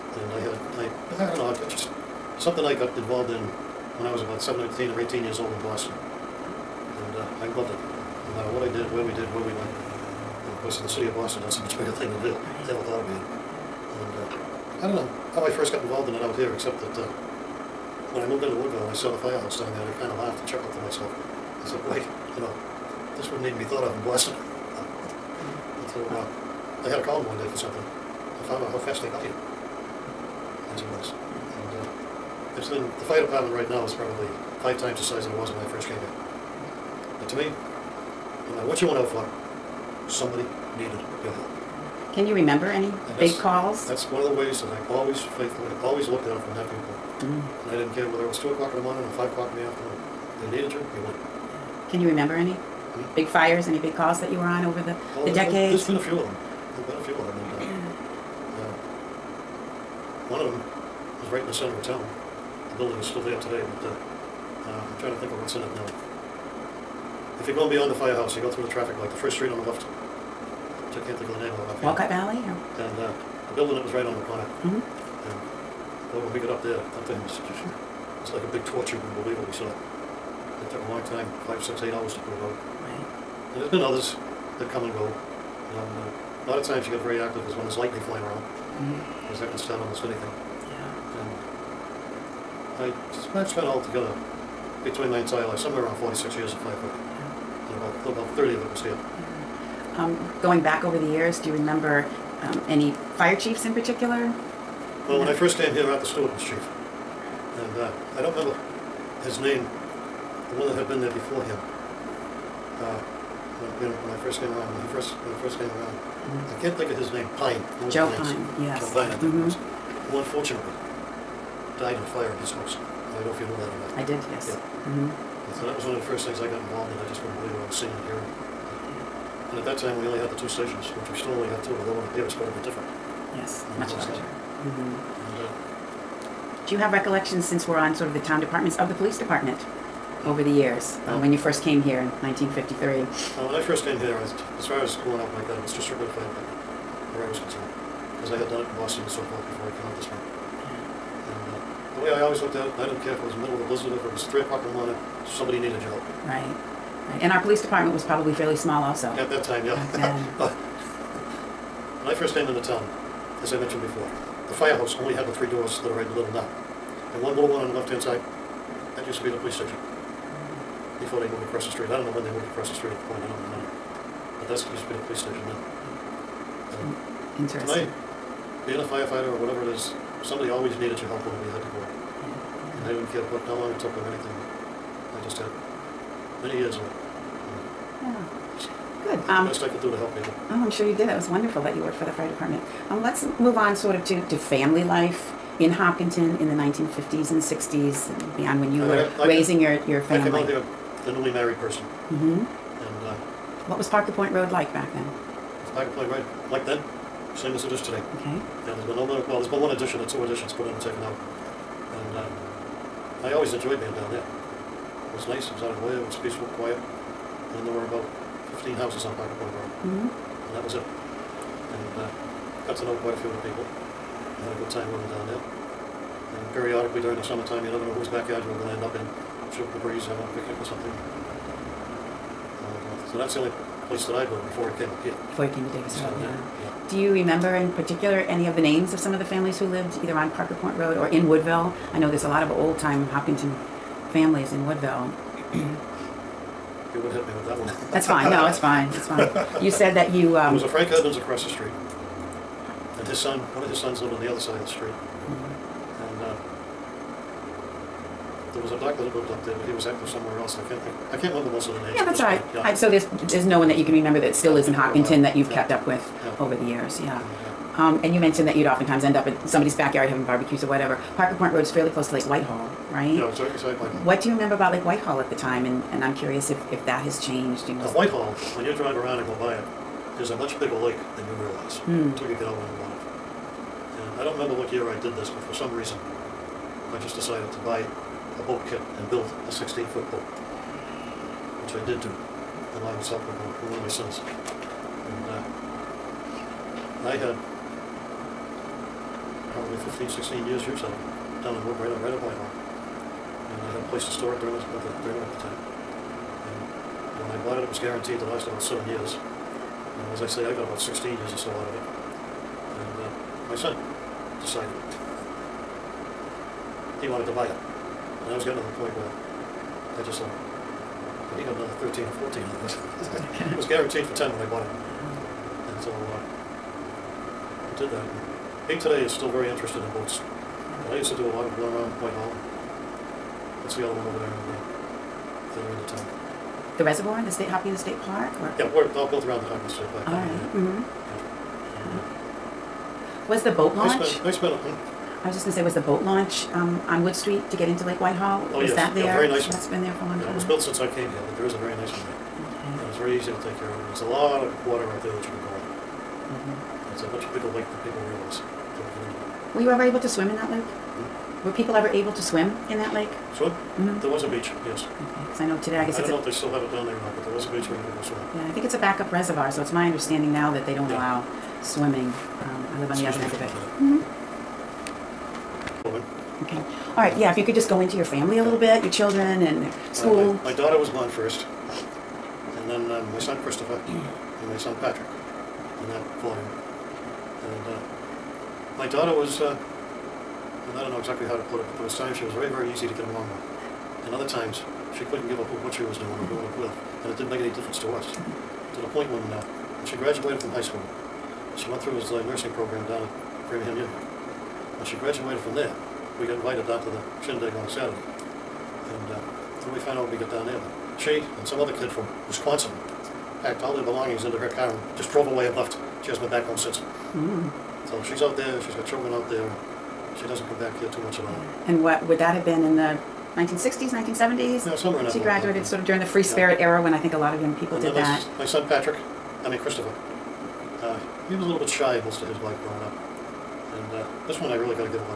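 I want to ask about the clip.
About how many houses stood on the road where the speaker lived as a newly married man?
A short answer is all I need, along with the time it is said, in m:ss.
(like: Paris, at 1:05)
15, at 3:37.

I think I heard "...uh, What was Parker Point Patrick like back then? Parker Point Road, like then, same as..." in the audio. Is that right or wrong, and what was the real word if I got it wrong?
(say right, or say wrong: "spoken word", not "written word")
wrong: "Road", not "Patrick".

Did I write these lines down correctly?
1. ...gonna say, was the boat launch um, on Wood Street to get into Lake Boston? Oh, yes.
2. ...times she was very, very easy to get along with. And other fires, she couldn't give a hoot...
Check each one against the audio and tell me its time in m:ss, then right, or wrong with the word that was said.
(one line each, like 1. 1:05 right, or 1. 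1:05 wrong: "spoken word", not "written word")
1. 5:45 wrong: "Whitehall", not "Boston"
2. 6:31 wrong: "times", not "fires".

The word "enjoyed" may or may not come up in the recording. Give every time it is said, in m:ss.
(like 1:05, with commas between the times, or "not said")
3:33.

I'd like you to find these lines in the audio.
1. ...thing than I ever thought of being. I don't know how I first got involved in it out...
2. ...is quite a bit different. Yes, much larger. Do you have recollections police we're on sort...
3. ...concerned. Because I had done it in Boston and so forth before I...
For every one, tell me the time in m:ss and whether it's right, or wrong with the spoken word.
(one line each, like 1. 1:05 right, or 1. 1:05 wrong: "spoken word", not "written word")
1. 0:11 right
2. 2:12 wrong: "since", not "police"
3. 2:27 right.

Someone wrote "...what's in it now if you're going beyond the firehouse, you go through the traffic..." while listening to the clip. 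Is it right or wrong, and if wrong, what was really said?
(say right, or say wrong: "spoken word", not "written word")
right.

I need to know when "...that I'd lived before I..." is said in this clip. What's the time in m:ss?
3:54.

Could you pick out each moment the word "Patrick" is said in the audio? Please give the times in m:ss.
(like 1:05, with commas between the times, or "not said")
6:24, 7:08.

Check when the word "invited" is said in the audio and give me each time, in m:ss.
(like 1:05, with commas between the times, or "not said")
6:46.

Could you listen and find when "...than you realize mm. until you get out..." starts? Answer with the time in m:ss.
4:41.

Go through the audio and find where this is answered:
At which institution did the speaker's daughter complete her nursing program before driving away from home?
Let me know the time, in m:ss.
6:43.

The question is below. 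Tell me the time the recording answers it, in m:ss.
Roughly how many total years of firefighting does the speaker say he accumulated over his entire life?
1:35.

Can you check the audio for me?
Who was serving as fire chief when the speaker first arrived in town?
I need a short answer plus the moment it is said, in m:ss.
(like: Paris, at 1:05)
Arthur Stewart, at 1:45.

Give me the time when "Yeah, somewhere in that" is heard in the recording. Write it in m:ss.
7:04.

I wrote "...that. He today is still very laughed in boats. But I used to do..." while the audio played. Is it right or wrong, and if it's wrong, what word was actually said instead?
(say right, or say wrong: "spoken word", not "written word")
wrong: "interested", not "laughed".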